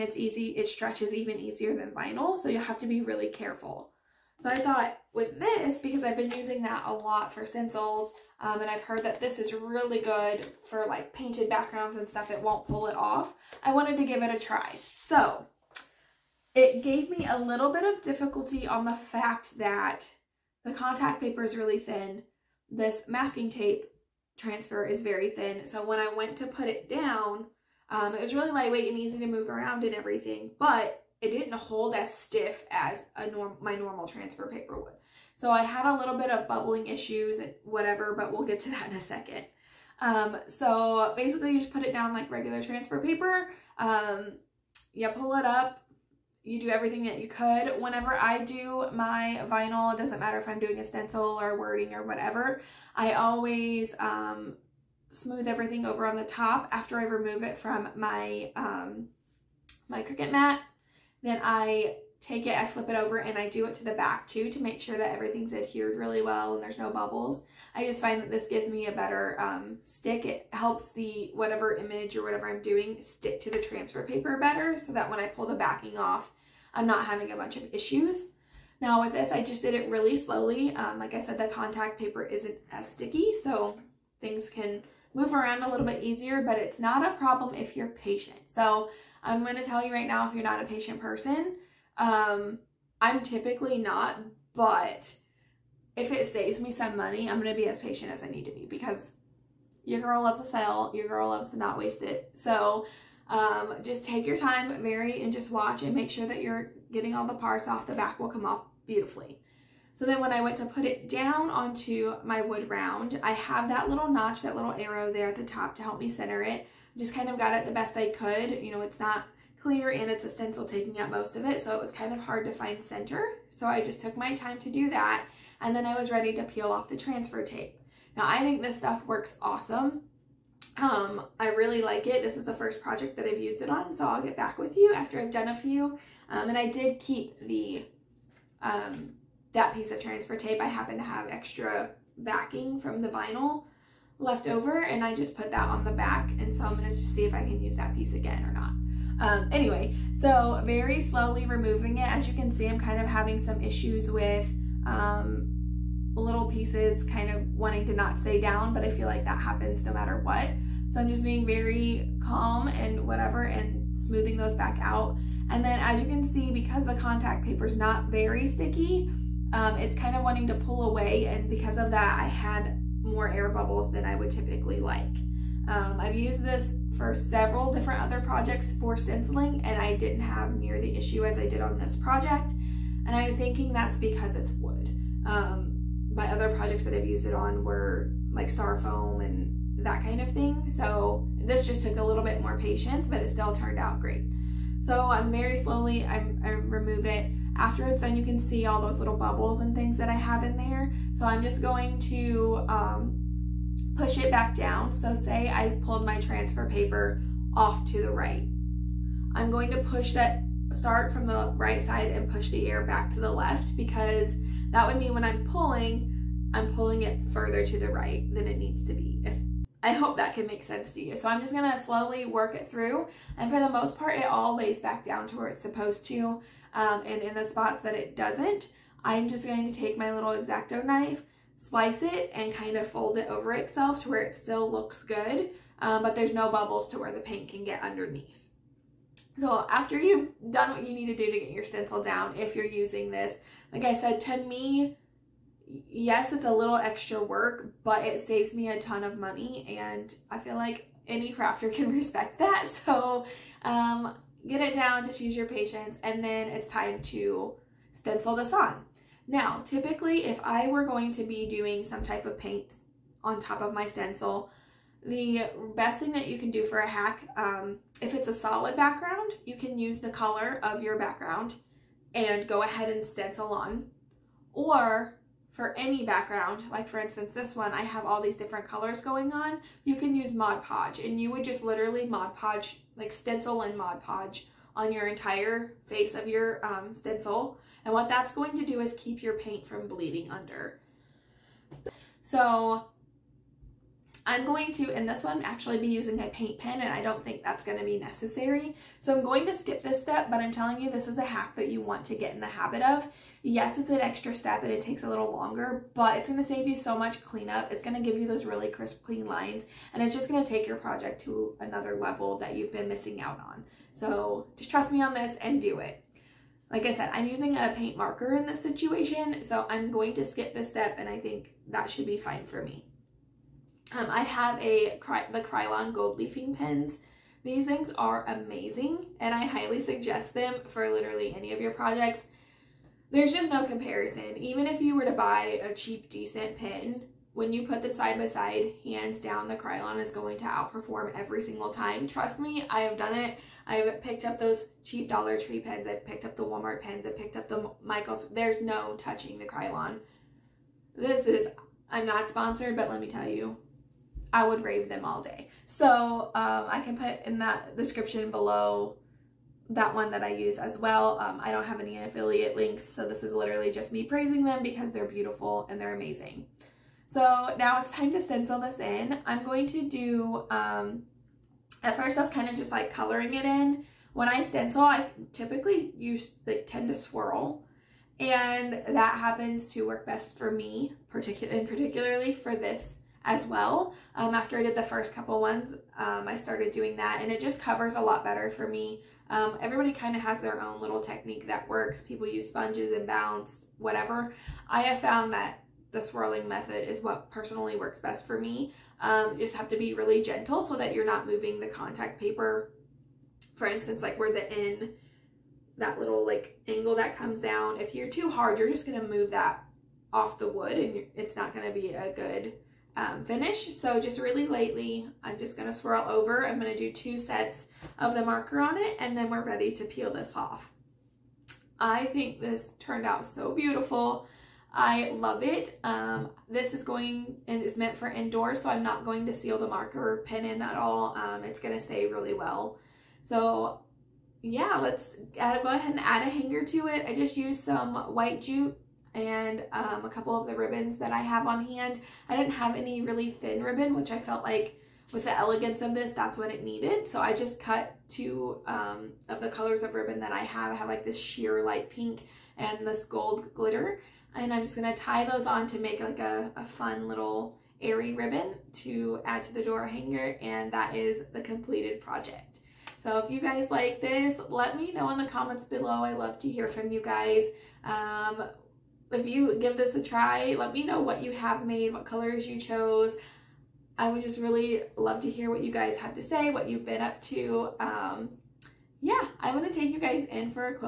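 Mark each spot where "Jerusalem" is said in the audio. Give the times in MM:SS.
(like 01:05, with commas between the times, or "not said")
not said.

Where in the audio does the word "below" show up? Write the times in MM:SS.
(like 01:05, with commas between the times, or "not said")
05:58, 07:45.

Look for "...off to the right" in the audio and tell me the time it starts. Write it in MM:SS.
03:27.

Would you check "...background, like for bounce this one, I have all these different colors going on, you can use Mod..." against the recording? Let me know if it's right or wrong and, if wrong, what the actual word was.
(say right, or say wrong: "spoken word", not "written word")
wrong: "instance", not "bounce".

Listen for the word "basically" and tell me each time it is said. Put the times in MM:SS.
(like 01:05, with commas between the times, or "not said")
00:41.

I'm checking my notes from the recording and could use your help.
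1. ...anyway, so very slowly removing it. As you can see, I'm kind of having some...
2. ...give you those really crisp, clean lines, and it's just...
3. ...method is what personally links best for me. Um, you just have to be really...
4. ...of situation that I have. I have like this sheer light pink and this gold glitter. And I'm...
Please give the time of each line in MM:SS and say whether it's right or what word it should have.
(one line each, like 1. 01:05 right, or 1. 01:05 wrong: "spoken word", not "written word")
1. 02:29 right
2. 05:08 right
3. 06:36 wrong: "works", not "links"
4. 07:29 wrong: "ribbon", not "situation".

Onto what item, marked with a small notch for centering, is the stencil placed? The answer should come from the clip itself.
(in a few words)
Wood round.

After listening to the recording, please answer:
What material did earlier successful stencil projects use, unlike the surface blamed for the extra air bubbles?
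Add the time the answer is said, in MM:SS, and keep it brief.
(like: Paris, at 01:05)
Star foam, at 03:08.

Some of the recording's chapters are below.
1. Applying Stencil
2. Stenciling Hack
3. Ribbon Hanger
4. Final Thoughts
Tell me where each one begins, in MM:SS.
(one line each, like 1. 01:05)
1. 00:46
2. 04:18
3. 07:00
4. 07:40.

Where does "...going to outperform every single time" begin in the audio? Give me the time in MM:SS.
05:40.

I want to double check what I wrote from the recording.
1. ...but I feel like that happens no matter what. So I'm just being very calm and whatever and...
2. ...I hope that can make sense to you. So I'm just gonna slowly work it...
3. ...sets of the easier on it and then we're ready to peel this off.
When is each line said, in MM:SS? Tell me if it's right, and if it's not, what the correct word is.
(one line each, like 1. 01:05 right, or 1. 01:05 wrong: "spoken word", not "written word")
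1. 02:38 right
2. 03:39 right
3. 06:57 wrong: "marker", not "easier".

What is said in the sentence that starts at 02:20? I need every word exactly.
I happen to have extra backing from the vinyl left over, and I just put that on the back.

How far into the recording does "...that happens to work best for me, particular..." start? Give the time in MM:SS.
06:18.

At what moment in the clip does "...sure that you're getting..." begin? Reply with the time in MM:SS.
01:46.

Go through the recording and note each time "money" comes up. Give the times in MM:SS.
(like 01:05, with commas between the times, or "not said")
01:36, 04:09.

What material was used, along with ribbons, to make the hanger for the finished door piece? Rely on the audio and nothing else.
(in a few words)
White jute.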